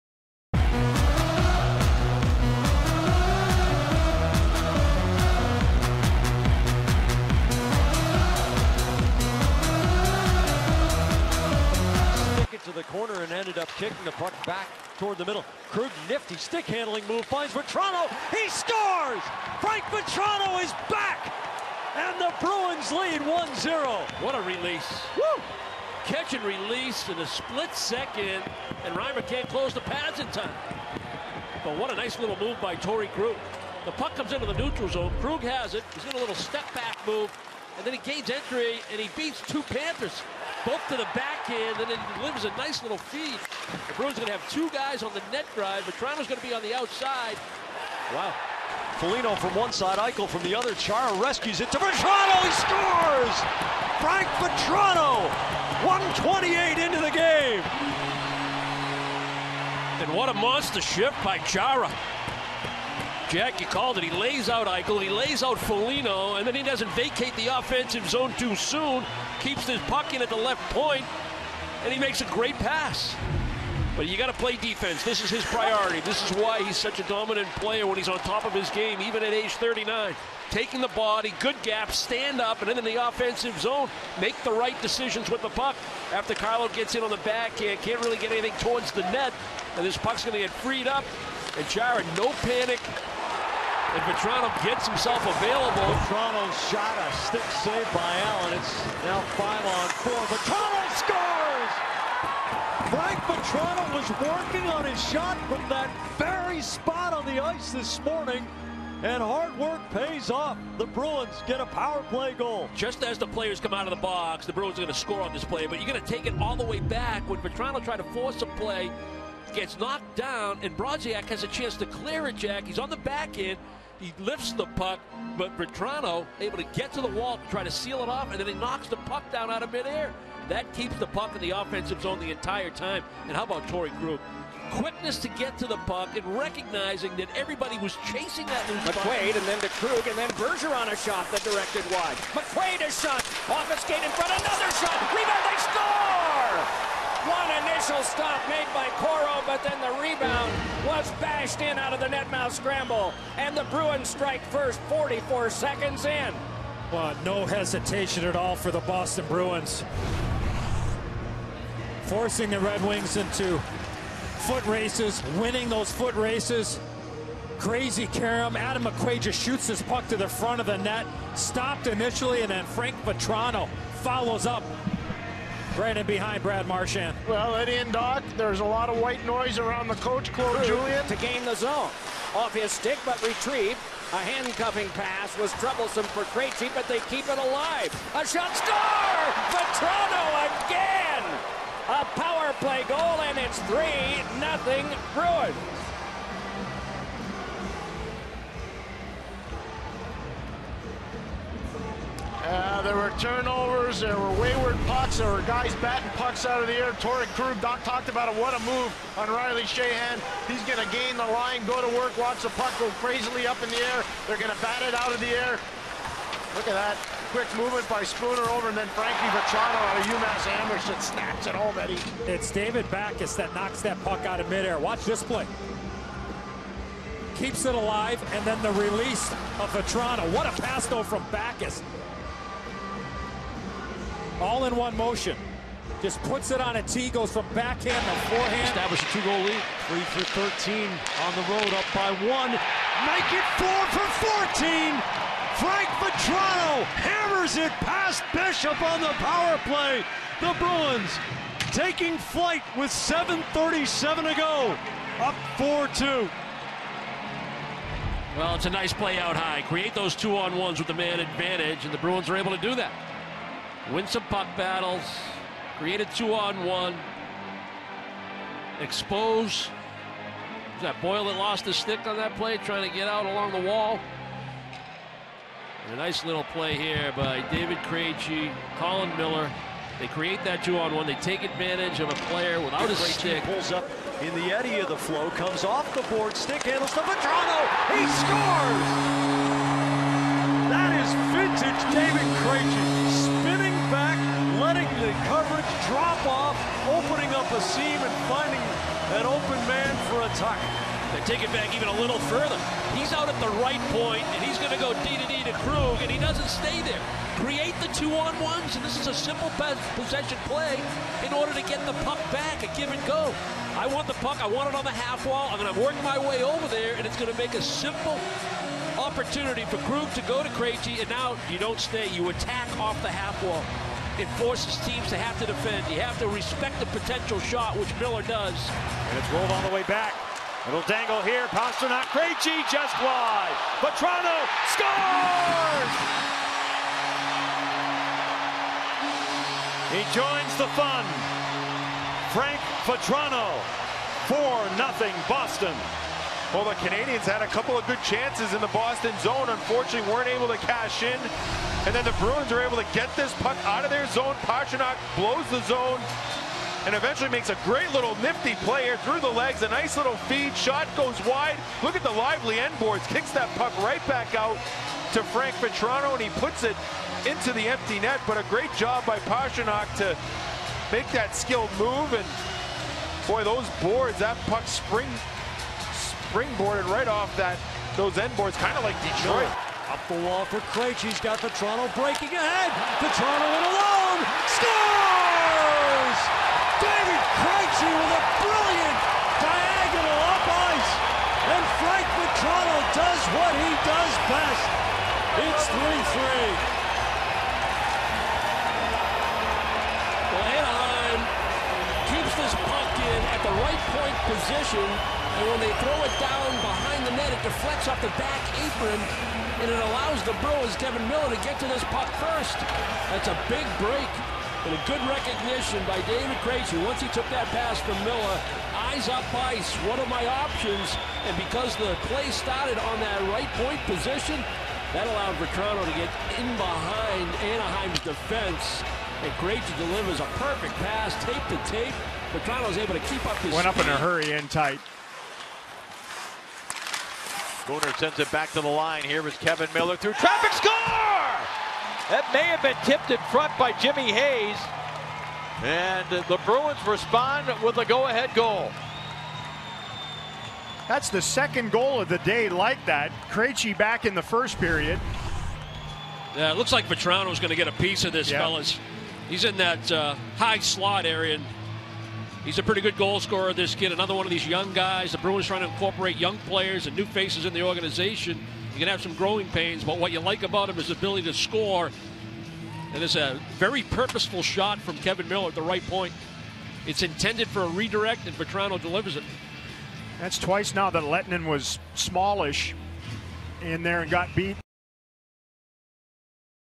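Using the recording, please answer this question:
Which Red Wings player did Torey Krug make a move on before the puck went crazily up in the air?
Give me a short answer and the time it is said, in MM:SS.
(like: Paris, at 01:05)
Riley Sheahan, at 03:29.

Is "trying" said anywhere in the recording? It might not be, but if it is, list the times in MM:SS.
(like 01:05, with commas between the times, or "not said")
04:32, 07:45.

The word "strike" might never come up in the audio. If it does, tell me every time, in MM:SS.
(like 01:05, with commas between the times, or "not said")
02:34.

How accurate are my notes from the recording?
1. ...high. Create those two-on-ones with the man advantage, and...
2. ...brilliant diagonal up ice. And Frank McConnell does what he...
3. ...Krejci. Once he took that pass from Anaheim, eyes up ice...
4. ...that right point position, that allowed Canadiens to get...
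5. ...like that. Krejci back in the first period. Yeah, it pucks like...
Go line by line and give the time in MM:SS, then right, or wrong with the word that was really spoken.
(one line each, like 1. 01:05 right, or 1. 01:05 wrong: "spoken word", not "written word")
1. 04:19 right
2. 06:28 right
3. 06:56 wrong: "Miller", not "Anaheim"
4. 07:02 wrong: "Vatrano", not "Canadiens"
5. 07:32 wrong: "looks", not "pucks".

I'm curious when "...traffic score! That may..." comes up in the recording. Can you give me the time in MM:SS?
07:20.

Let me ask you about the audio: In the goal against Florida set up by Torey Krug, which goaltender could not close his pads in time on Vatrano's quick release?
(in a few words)
Reimer.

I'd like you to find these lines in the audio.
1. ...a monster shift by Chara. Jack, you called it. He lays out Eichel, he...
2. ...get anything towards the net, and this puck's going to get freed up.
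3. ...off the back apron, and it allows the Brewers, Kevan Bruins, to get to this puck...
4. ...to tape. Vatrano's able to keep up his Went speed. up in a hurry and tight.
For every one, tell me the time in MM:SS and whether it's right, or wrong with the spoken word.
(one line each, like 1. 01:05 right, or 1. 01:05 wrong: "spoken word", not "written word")
1. 01:00 right
2. 01:28 right
3. 06:47 wrong: "Miller", not "Bruins"
4. 07:11 right.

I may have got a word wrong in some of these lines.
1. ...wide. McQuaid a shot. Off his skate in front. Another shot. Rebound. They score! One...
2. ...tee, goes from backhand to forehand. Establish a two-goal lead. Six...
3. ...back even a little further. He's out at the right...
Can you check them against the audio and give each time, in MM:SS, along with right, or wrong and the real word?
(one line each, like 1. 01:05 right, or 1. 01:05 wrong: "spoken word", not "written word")
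1. 02:21 right
2. 03:56 wrong: "Three", not "Six"
3. 05:01 right.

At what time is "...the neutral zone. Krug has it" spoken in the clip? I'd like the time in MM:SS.
00:34.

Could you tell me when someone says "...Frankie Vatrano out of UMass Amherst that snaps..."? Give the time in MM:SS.
03:38.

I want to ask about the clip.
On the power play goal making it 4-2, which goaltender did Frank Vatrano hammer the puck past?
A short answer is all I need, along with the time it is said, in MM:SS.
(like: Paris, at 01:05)
Bishop, at 04:08.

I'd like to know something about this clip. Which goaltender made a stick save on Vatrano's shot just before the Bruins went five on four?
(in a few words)
Allen.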